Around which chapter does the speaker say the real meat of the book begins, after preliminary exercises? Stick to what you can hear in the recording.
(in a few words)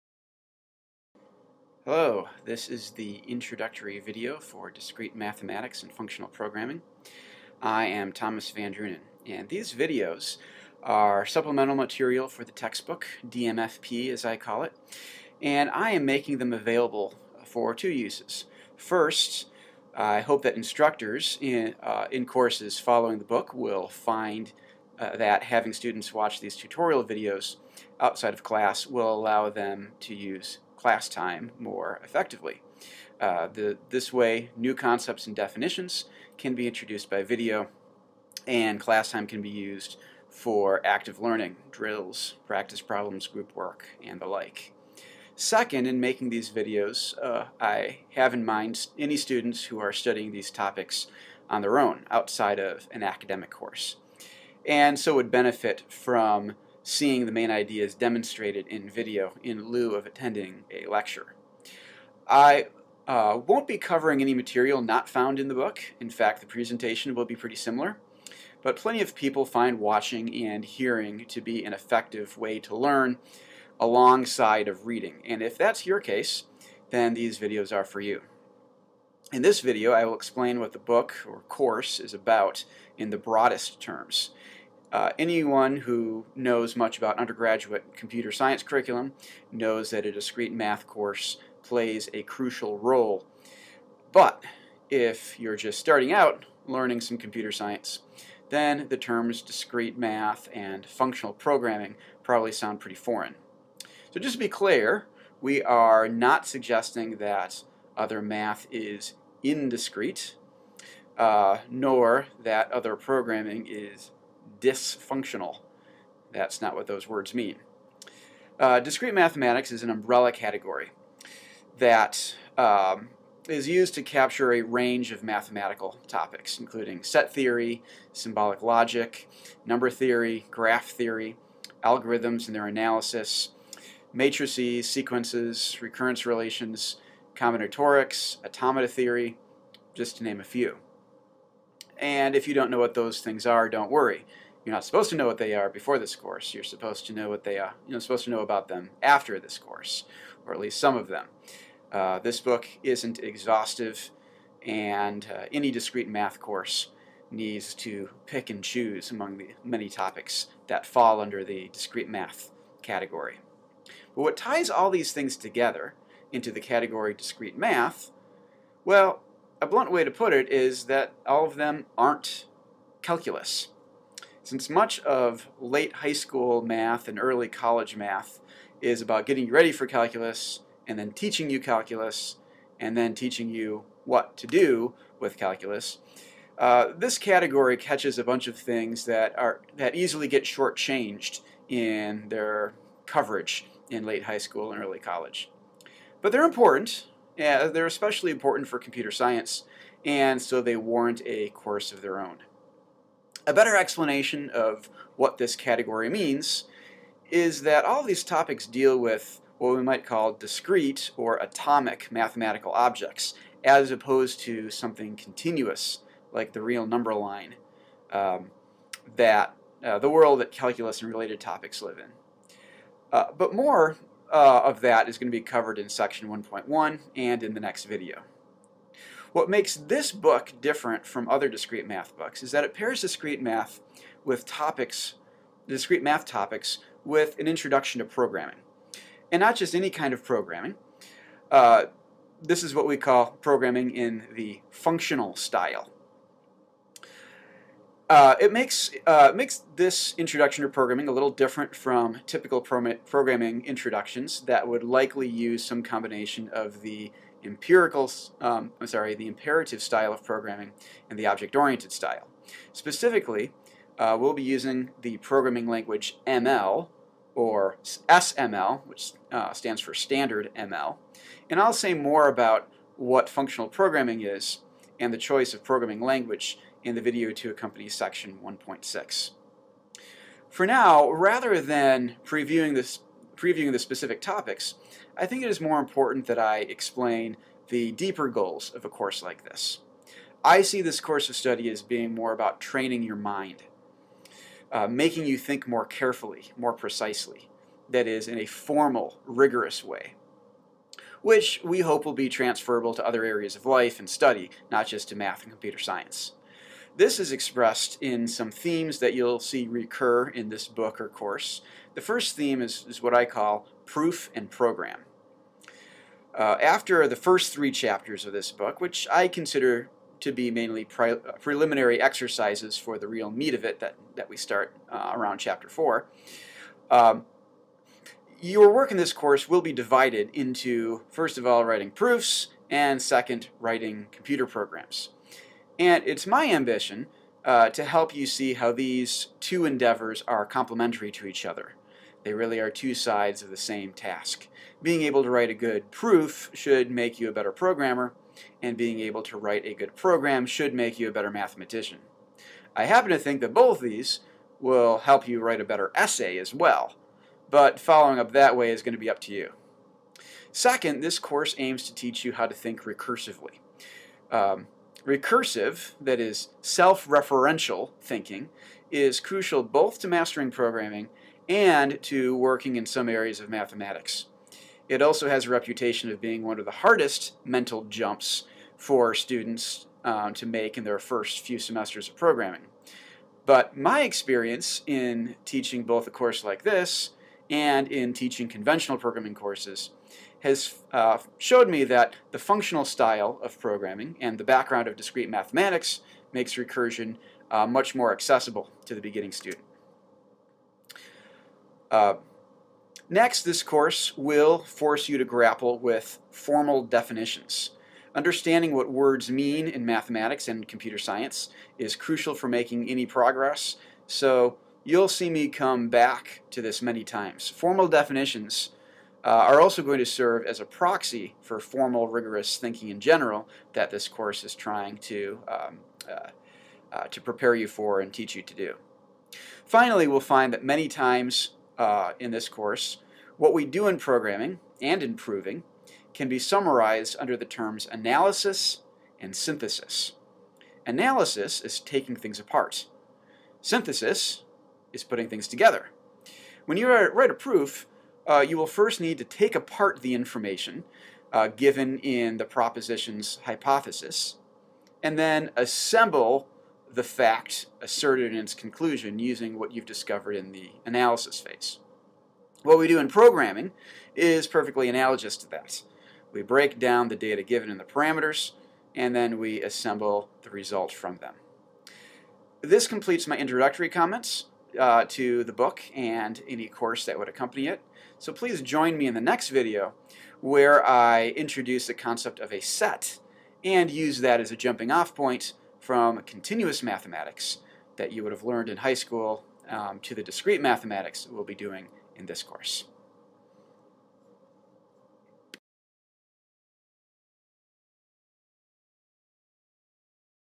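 Chapter 4.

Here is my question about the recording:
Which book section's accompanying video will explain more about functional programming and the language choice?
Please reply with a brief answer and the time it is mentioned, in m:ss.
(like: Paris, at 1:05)
Section 1.6, at 4:38.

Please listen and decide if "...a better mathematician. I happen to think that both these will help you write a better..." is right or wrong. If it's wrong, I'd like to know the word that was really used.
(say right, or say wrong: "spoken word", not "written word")
right.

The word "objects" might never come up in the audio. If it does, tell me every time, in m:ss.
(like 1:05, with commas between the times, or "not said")
3:32, 4:21.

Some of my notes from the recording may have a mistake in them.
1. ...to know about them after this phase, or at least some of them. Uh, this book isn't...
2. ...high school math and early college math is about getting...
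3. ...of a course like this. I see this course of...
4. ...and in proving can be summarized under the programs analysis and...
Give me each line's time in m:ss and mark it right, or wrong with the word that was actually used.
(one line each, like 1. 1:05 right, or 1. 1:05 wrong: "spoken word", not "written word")
1. 2:28 wrong: "course", not "phase"
2. 2:55 right
3. 4:48 right
4. 7:14 wrong: "terms", not "programs".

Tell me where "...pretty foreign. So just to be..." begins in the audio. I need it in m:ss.
1:42.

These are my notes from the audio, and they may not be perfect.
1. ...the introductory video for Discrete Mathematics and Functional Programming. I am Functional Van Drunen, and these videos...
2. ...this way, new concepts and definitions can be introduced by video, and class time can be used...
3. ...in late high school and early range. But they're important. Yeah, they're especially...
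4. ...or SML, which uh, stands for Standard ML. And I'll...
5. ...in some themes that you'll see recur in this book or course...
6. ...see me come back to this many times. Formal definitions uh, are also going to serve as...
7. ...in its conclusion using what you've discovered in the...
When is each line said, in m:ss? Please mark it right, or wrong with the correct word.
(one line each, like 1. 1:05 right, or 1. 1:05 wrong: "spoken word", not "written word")
1. 0:02 wrong: "Thomas", not "Functional"
2. 0:33 right
3. 3:13 wrong: "college", not "range"
4. 4:27 right
5. 5:08 right
6. 6:55 right
7. 7:38 right.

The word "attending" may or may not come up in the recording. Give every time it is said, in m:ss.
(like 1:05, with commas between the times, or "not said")
1:00.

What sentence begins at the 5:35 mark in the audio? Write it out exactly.
And it's my ambition uh, to help you see how these two endeavors are complementary to each other.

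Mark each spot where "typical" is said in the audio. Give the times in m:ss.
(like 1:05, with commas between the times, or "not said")
4:12.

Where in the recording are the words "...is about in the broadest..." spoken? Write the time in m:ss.
1:21.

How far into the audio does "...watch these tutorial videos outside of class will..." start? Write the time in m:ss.
0:26.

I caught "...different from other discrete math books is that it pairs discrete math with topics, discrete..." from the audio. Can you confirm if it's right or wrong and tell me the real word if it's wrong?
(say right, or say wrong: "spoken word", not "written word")
right.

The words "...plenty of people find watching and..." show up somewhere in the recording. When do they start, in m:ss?
1:08.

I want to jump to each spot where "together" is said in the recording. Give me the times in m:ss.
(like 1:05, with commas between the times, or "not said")
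2:45, 7:25.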